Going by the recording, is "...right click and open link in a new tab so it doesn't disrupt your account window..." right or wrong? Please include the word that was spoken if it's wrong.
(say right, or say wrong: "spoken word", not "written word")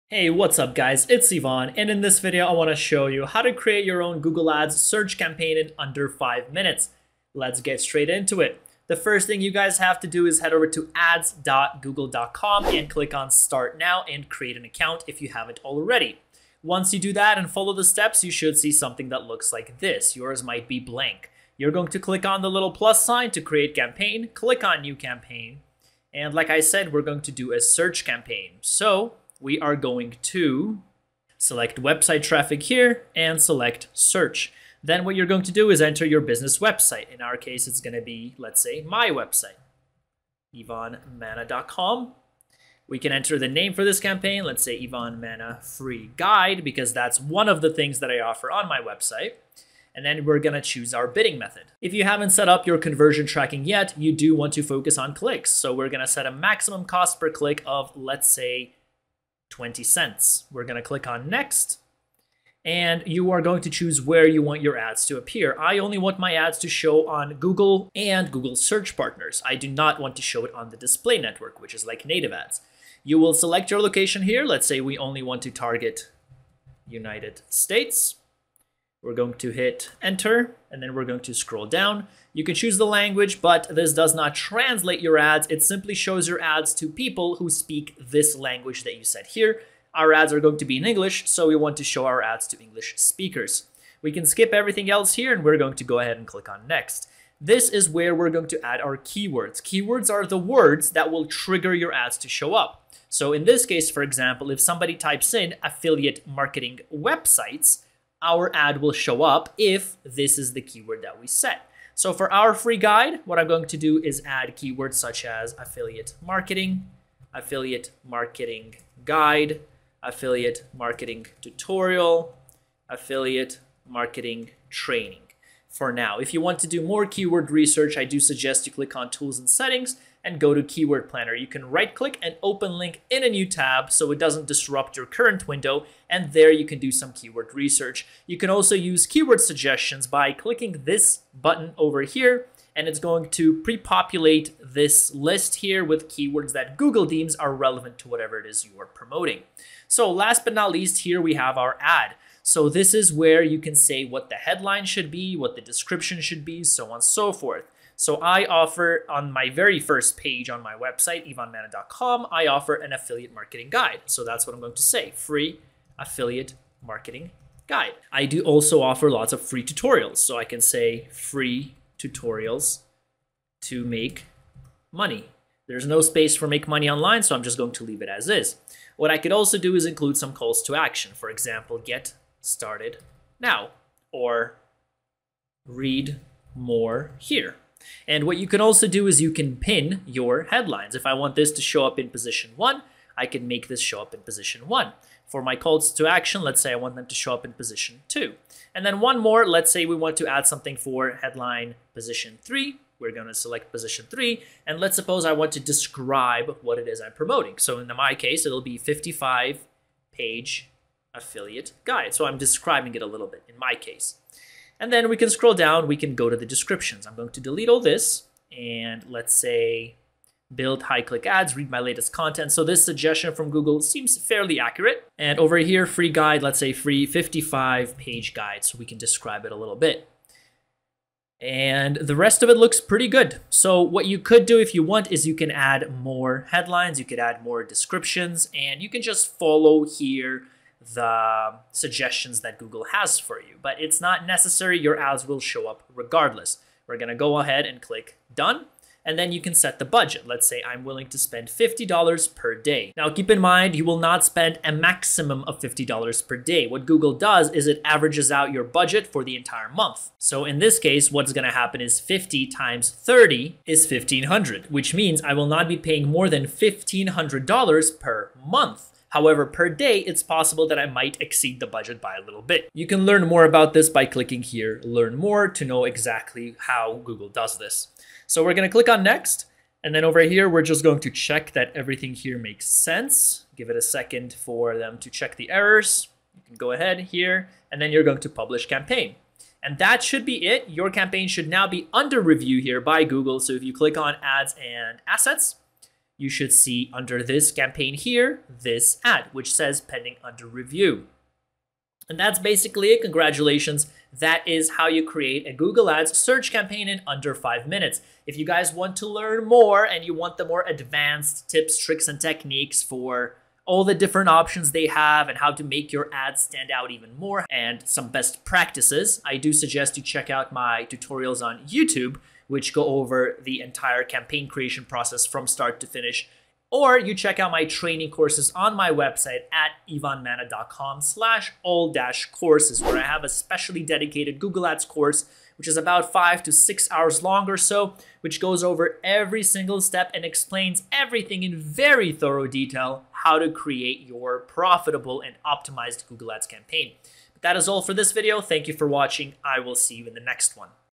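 wrong: "current", not "account".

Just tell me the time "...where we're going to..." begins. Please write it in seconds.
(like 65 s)
97 s.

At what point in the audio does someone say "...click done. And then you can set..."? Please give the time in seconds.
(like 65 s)
247 s.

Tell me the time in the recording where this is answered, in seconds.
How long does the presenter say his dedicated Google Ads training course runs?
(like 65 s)
336 s.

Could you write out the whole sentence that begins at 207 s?
So in my case, it'll be 55 page affiliate guide.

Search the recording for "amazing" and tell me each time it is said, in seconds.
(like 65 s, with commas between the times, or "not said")
not said.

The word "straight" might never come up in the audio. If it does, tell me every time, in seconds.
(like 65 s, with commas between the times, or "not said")
7 s.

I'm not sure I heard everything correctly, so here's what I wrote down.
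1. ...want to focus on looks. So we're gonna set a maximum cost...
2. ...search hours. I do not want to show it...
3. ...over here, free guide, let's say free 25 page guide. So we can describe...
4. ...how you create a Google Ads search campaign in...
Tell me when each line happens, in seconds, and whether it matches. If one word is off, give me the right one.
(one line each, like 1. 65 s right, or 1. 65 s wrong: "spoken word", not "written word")
1. 54 s wrong: "clicks", not "looks"
2. 68 s wrong: "partners", not "hours"
3. 225 s wrong: "55", not "25"
4. 304 s right.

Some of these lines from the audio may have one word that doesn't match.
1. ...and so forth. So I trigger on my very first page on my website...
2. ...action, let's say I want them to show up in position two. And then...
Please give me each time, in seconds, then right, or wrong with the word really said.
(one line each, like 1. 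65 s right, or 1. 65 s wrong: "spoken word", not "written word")
1. 156 s wrong: "offer", not "trigger"
2. 196 s right.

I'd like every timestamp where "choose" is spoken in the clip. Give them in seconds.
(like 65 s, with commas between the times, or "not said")
50 s, 63 s, 82 s.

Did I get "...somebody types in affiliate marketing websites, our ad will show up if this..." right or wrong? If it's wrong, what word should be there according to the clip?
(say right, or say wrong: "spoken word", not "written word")
right.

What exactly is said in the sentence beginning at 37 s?
In our case, it's going to be, let's say, my website, ivanmana.com.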